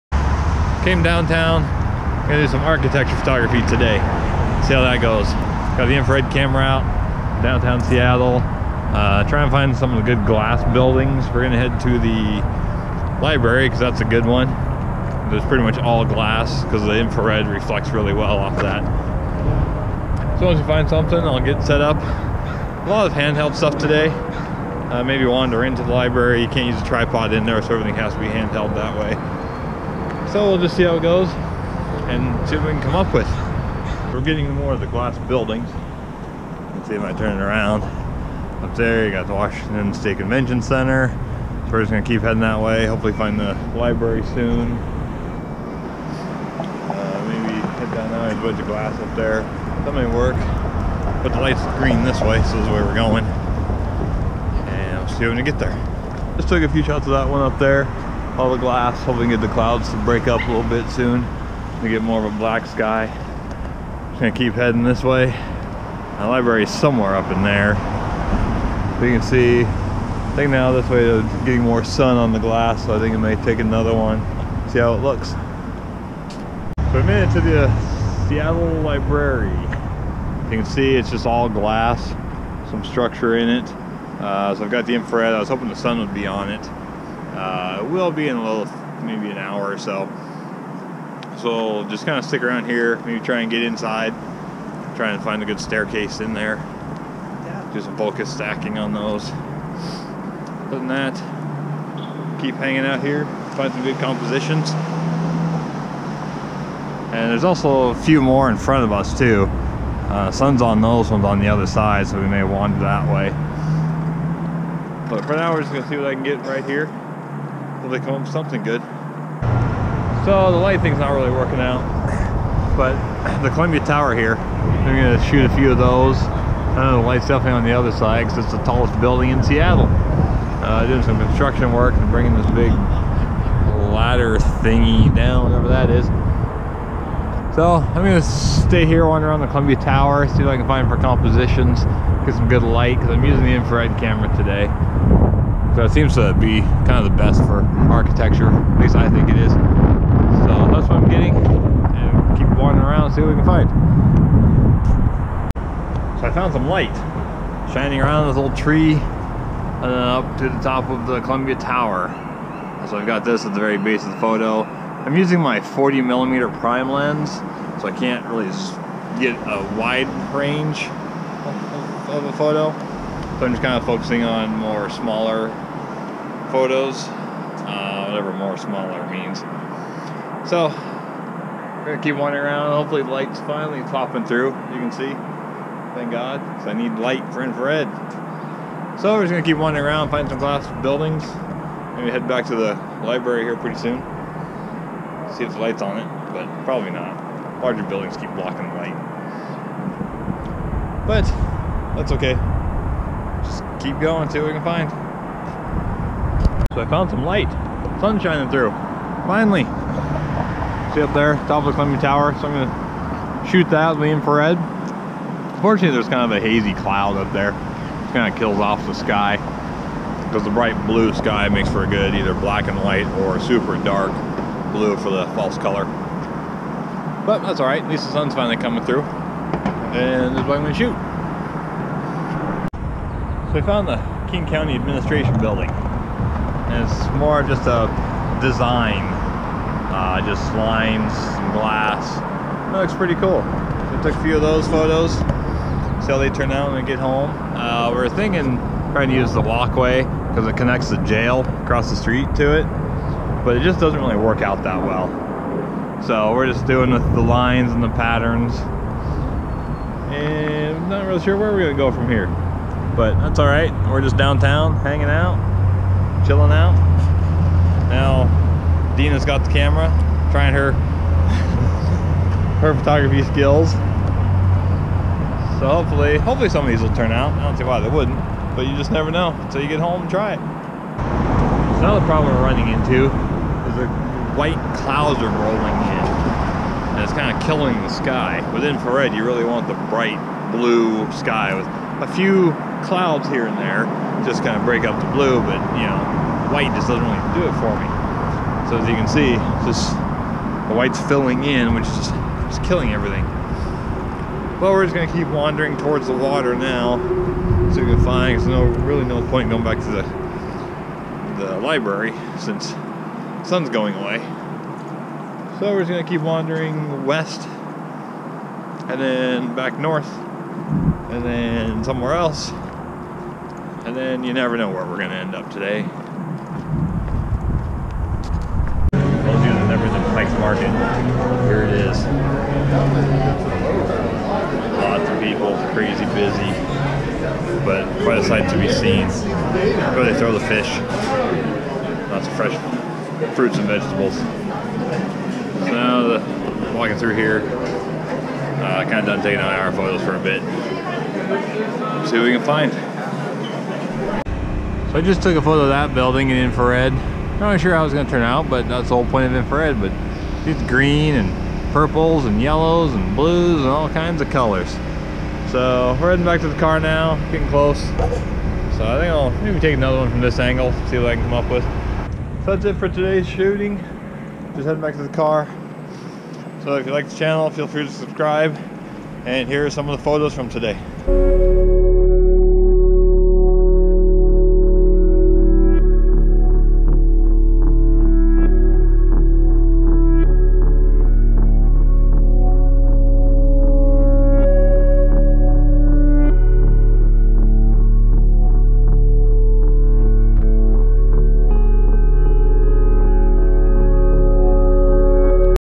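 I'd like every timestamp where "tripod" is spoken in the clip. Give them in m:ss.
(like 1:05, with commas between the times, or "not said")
0:26.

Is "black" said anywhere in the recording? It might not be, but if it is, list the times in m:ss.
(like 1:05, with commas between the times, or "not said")
1:02, 3:42.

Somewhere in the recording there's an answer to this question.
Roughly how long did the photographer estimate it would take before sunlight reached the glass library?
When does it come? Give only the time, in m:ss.
1:29.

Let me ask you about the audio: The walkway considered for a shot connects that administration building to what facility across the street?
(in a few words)
the jail.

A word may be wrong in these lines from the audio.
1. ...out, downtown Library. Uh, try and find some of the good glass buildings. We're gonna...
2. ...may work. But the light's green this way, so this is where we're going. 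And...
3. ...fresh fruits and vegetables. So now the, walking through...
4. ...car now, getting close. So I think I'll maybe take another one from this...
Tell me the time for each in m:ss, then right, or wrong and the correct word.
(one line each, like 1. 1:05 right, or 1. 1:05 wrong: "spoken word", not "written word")
1. 0:06 wrong: "Seattle", not "Library"
2. 0:49 right
3. 5:42 right
4. 6:06 right.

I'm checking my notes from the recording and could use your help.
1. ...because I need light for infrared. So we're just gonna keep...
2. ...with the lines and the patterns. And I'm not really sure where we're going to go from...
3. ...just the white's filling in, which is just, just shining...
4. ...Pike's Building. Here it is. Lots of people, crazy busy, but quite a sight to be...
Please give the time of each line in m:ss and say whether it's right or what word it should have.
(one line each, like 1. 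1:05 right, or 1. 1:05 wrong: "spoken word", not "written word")
1. 3:06 right
2. 4:16 right
3. 4:59 wrong: "killing", not "shining"
4. 5:30 wrong: "Market", not "Building".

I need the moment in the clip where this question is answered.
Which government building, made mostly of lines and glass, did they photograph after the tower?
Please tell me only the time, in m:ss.
3:54.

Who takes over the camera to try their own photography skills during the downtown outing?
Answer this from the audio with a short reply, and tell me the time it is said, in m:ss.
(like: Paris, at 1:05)
Dina, at 4:28.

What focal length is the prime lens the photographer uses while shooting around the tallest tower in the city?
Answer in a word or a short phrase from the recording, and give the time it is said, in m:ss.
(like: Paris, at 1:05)
40 millimeter, at 2:45.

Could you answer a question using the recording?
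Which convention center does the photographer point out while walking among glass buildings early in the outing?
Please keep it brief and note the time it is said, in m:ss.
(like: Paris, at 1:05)
Washington State Convention Center, at 0:39.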